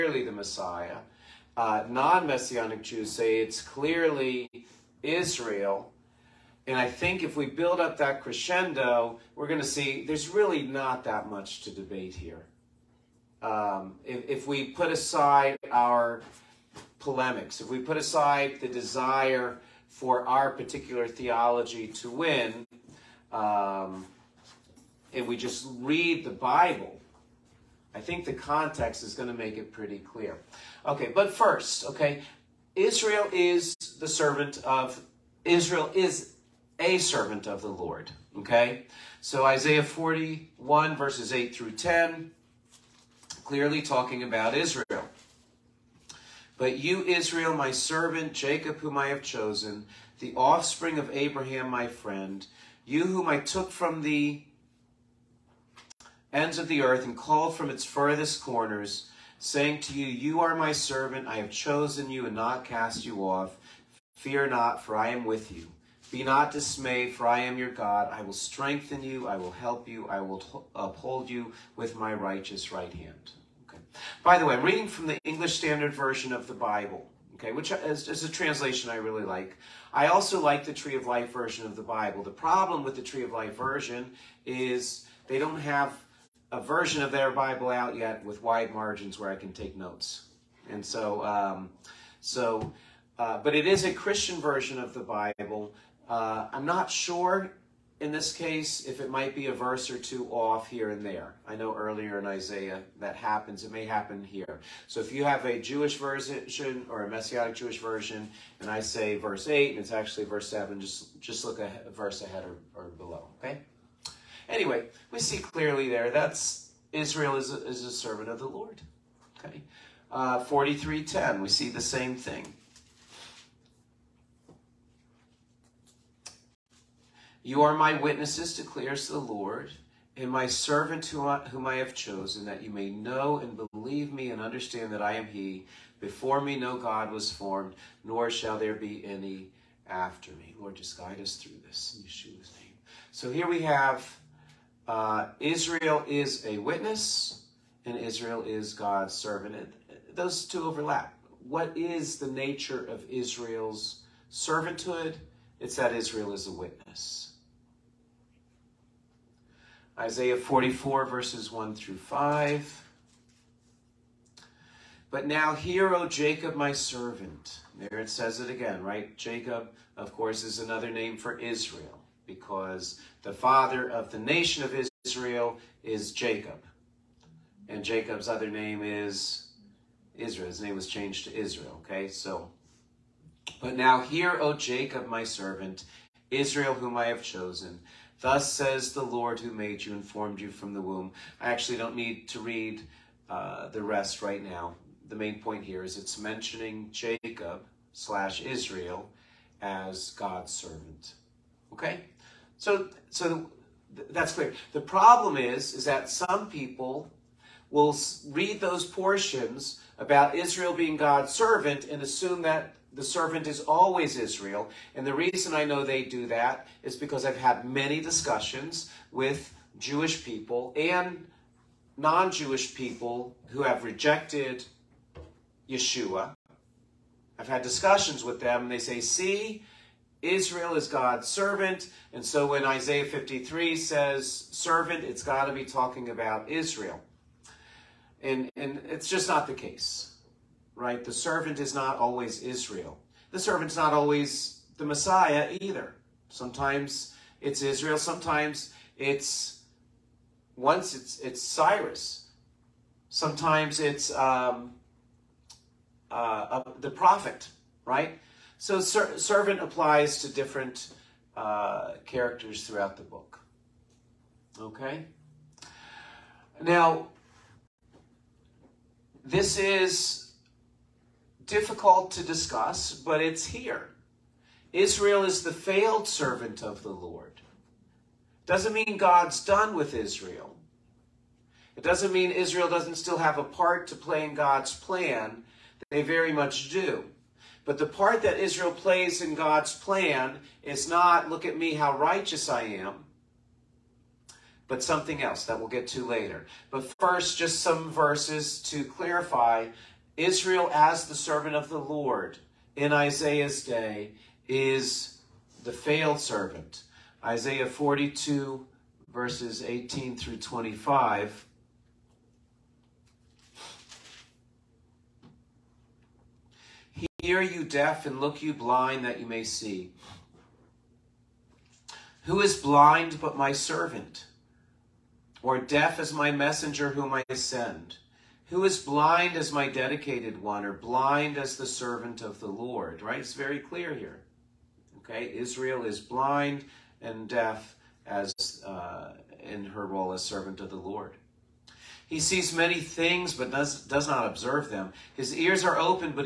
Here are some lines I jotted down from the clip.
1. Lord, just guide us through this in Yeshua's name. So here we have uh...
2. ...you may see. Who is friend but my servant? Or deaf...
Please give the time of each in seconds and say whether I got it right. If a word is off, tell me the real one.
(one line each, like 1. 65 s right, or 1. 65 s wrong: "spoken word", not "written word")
1. 140 s right
2. 319 s wrong: "blind", not "friend".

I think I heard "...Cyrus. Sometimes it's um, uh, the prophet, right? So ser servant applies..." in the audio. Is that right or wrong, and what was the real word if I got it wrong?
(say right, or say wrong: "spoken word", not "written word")
right.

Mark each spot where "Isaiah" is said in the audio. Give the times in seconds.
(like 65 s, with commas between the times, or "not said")
39 s, 102 s, 159 s, 232 s, 302 s, 307 s.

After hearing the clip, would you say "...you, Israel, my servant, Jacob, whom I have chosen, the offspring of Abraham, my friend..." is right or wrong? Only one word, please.
right.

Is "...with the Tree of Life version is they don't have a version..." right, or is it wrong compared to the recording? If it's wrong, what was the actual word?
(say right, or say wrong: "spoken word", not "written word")
right.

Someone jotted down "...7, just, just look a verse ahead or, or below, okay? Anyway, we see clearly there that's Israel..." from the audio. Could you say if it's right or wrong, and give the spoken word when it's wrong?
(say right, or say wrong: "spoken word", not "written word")
right.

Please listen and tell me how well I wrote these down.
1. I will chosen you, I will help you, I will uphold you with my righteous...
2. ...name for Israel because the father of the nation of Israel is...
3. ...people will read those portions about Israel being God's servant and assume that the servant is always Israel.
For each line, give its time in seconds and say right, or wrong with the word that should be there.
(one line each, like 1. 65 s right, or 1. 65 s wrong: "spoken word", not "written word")
1. 68 s wrong: "strengthen", not "chosen"
2. 170 s right
3. 206 s right.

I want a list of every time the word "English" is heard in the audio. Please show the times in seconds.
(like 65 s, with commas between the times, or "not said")
75 s.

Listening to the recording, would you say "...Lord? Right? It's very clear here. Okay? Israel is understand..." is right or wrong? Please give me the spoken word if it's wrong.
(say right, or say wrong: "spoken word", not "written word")
wrong: "blind", not "understand".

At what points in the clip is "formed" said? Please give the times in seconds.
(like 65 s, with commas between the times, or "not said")
137 s, 190 s.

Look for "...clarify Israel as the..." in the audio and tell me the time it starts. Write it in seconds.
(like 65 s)
298 s.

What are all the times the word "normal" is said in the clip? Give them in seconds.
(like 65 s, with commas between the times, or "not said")
not said.